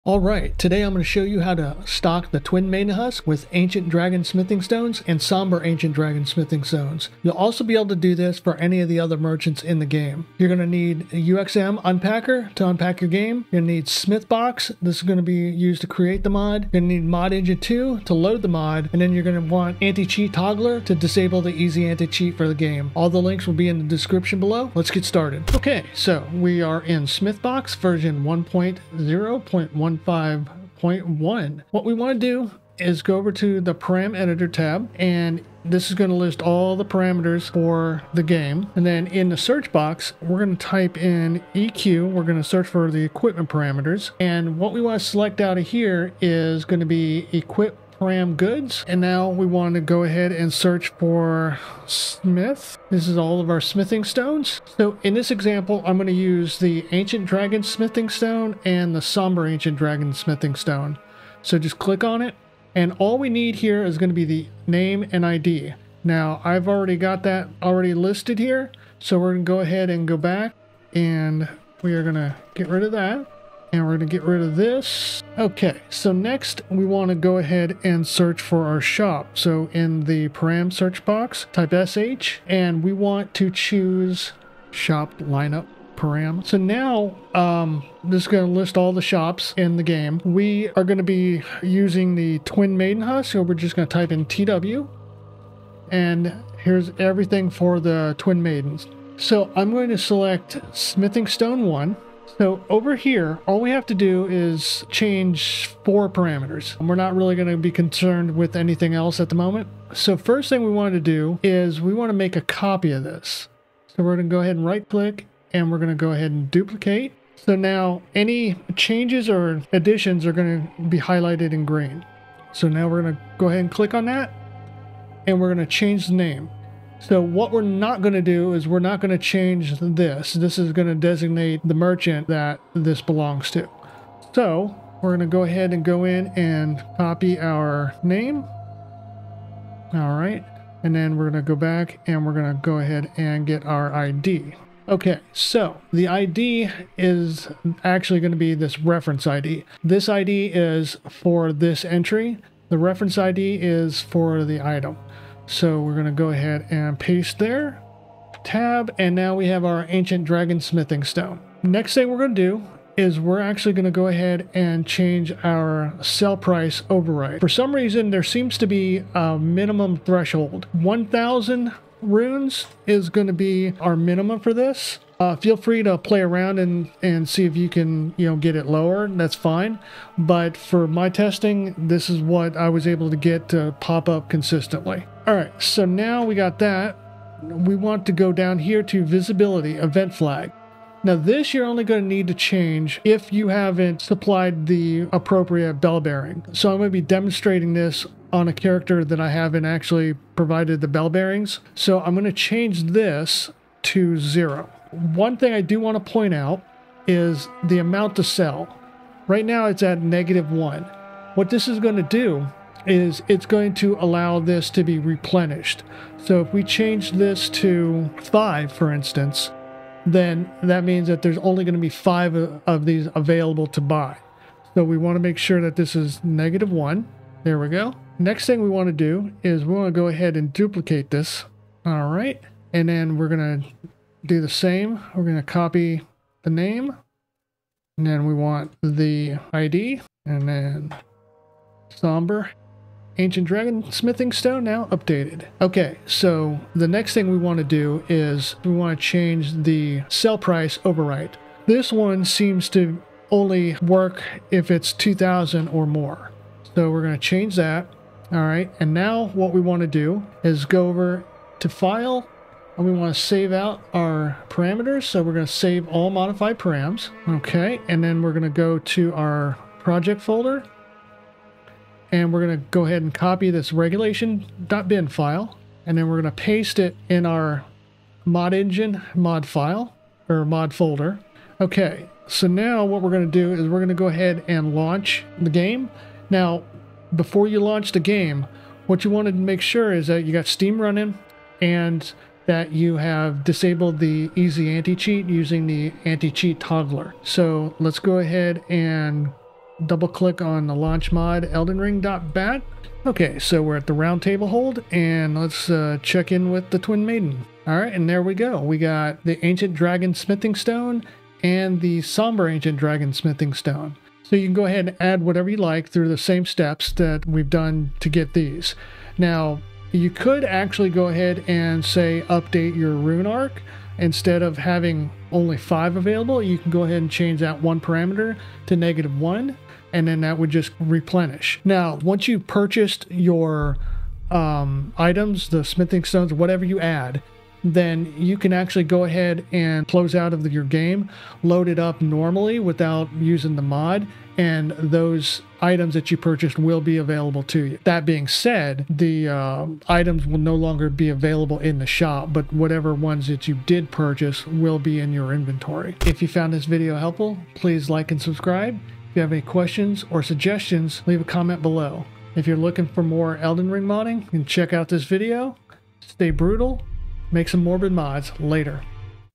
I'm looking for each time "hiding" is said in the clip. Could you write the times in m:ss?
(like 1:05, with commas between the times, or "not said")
not said.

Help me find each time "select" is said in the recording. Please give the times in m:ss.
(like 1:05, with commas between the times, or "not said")
0:45, 1:39.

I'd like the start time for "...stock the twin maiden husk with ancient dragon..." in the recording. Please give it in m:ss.
0:01.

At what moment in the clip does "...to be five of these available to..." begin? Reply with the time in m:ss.
3:41.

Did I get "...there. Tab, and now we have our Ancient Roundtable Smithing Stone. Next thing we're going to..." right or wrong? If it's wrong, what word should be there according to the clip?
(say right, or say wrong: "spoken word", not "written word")
wrong: "Dragon", not "Roundtable".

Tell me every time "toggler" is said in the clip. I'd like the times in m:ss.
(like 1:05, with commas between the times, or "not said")
0:20, 4:56.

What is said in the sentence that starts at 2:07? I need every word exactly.
So what we're not going to do is we're not going to change this.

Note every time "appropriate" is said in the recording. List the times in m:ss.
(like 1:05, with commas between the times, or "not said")
3:15.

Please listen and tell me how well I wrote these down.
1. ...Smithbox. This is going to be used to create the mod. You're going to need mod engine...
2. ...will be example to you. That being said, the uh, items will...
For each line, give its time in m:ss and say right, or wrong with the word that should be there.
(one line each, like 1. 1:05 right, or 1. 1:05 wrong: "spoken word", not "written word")
1. 0:13 right
2. 5:46 wrong: "available", not "example".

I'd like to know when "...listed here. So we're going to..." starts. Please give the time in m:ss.
1:07.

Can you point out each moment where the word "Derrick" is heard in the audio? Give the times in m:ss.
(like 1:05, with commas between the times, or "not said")
not said.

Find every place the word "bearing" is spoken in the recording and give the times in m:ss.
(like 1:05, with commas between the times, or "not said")
3:15, 3:21.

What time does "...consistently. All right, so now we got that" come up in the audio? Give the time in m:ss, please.
3:04.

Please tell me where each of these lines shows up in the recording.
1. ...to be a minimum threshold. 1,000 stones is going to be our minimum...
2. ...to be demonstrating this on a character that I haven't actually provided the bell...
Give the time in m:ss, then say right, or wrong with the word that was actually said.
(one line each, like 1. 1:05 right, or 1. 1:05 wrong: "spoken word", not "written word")
1. 2:48 wrong: "runes", not "stones"
2. 3:16 right.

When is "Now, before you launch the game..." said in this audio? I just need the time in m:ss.
4:46.